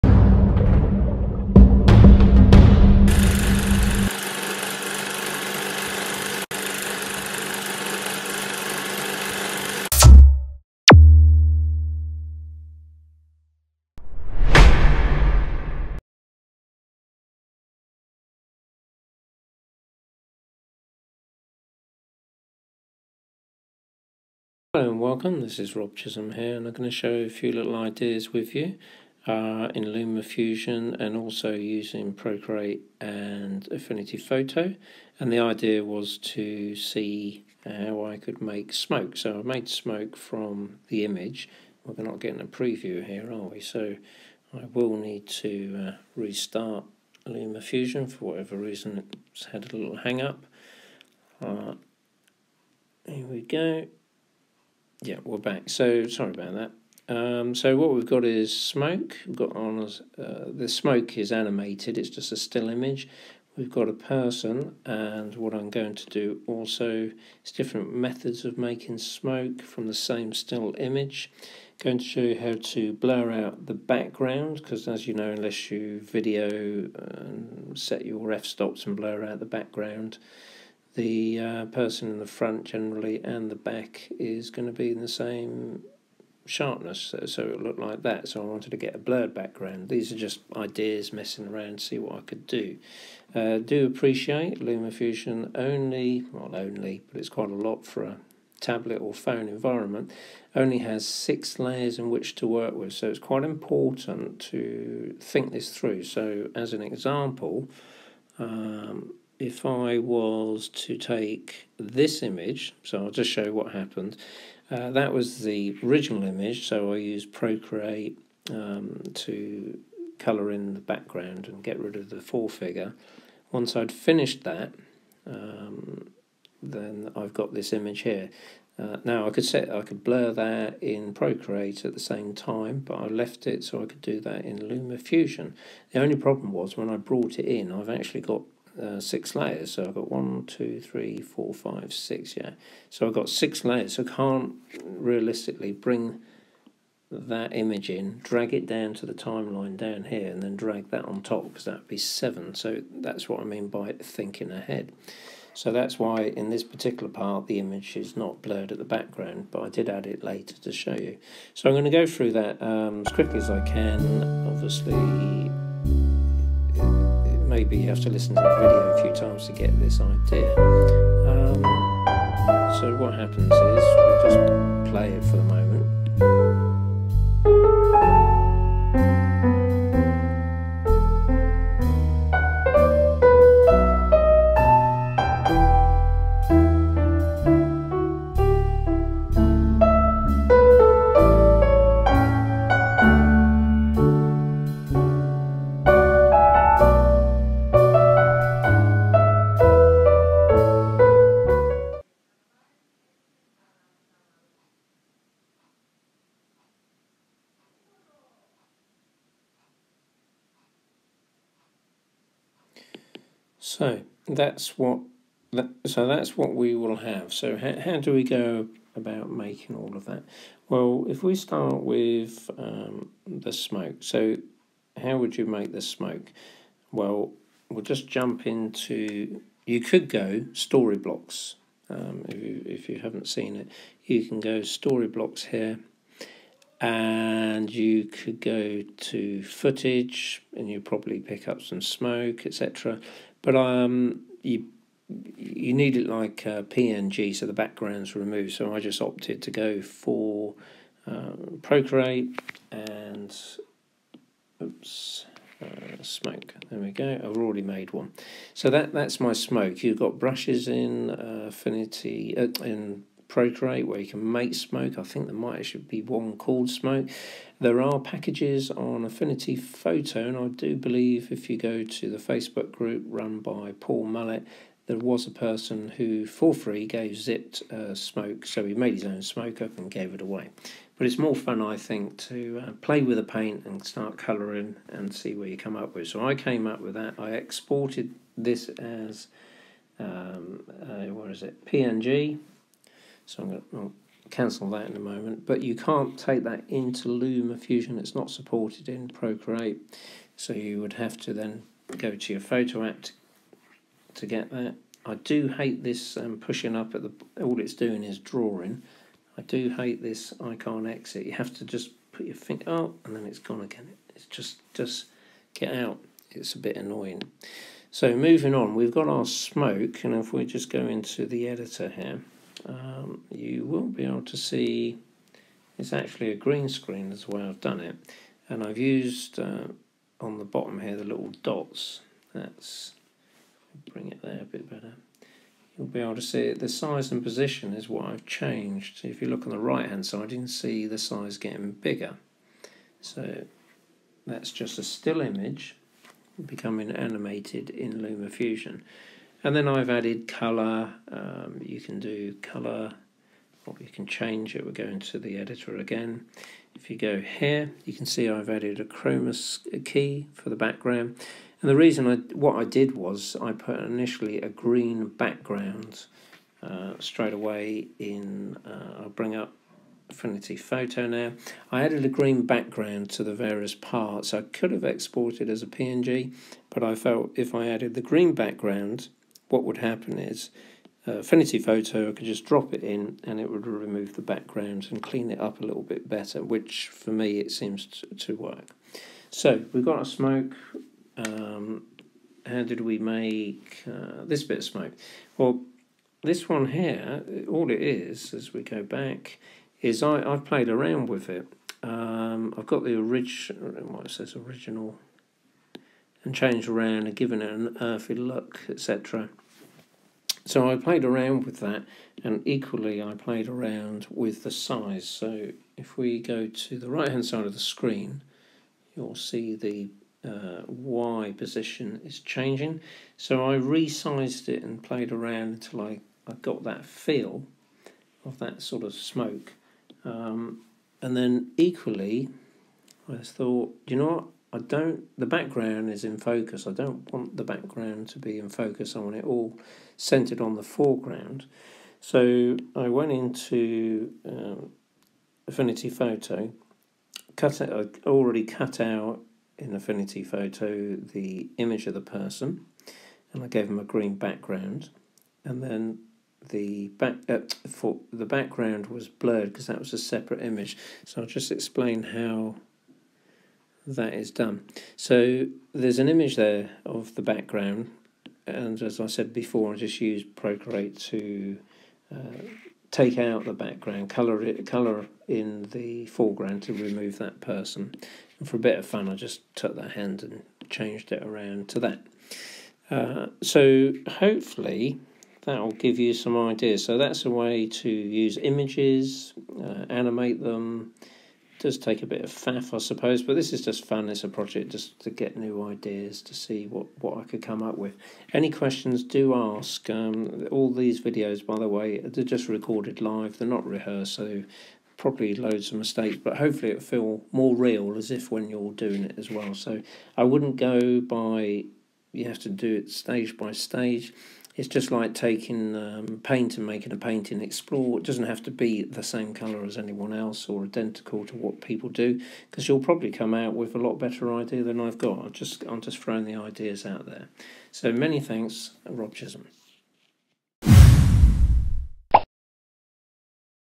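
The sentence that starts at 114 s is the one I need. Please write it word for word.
Uh, that was the original image, so I used Procreate um, to colour in the background and get rid of the four-figure.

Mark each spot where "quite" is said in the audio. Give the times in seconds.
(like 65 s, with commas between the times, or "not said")
97 s, 103 s.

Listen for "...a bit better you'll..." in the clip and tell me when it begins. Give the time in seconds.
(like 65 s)
334 s.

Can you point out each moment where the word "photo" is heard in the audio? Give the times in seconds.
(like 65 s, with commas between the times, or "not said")
34 s, 269 s, 302 s, 370 s, 381 s, 445 s, 450 s.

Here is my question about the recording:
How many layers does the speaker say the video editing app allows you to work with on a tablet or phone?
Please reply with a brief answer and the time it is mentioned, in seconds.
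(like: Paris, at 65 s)
6, at 101 s.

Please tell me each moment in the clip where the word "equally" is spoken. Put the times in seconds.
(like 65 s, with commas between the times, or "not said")
412 s, 431 s.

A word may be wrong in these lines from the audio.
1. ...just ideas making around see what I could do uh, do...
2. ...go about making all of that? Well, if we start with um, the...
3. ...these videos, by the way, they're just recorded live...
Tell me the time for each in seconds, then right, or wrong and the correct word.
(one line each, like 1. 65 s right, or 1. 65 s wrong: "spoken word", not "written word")
1. 90 s wrong: "messing", not "making"
2. 218 s right
3. 500 s right.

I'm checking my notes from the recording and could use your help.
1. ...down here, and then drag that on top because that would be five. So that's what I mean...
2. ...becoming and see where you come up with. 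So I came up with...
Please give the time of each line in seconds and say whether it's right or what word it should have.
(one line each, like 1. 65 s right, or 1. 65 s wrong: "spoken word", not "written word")
1. 149 s wrong: "seven", not "five"
2. 284 s wrong: "colouring", not "becoming".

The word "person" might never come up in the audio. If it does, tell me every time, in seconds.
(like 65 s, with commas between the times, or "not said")
63 s, 81 s, 275 s, 452 s, 477 s.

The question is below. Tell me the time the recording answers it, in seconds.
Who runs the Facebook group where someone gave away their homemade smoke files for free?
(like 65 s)
273 s.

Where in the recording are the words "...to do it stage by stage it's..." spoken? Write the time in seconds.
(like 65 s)
512 s.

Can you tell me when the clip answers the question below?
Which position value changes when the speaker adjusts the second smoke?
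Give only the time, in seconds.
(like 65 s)
420 s.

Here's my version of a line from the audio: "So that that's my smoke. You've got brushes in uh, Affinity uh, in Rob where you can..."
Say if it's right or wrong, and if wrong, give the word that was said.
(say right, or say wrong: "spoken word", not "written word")
wrong: "Procreate", not "Rob".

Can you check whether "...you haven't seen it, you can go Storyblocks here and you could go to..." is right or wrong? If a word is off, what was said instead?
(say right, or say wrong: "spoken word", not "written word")
right.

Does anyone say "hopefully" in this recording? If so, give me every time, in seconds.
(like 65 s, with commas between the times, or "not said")
484 s, 506 s.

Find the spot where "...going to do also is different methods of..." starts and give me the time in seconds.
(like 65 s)
65 s.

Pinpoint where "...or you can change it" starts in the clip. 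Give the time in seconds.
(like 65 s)
353 s.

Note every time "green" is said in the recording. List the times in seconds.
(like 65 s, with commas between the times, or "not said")
326 s, 364 s, 372 s, 378 s, 453 s.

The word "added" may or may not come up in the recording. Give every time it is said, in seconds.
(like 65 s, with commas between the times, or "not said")
349 s, 358 s, 371 s, 377 s.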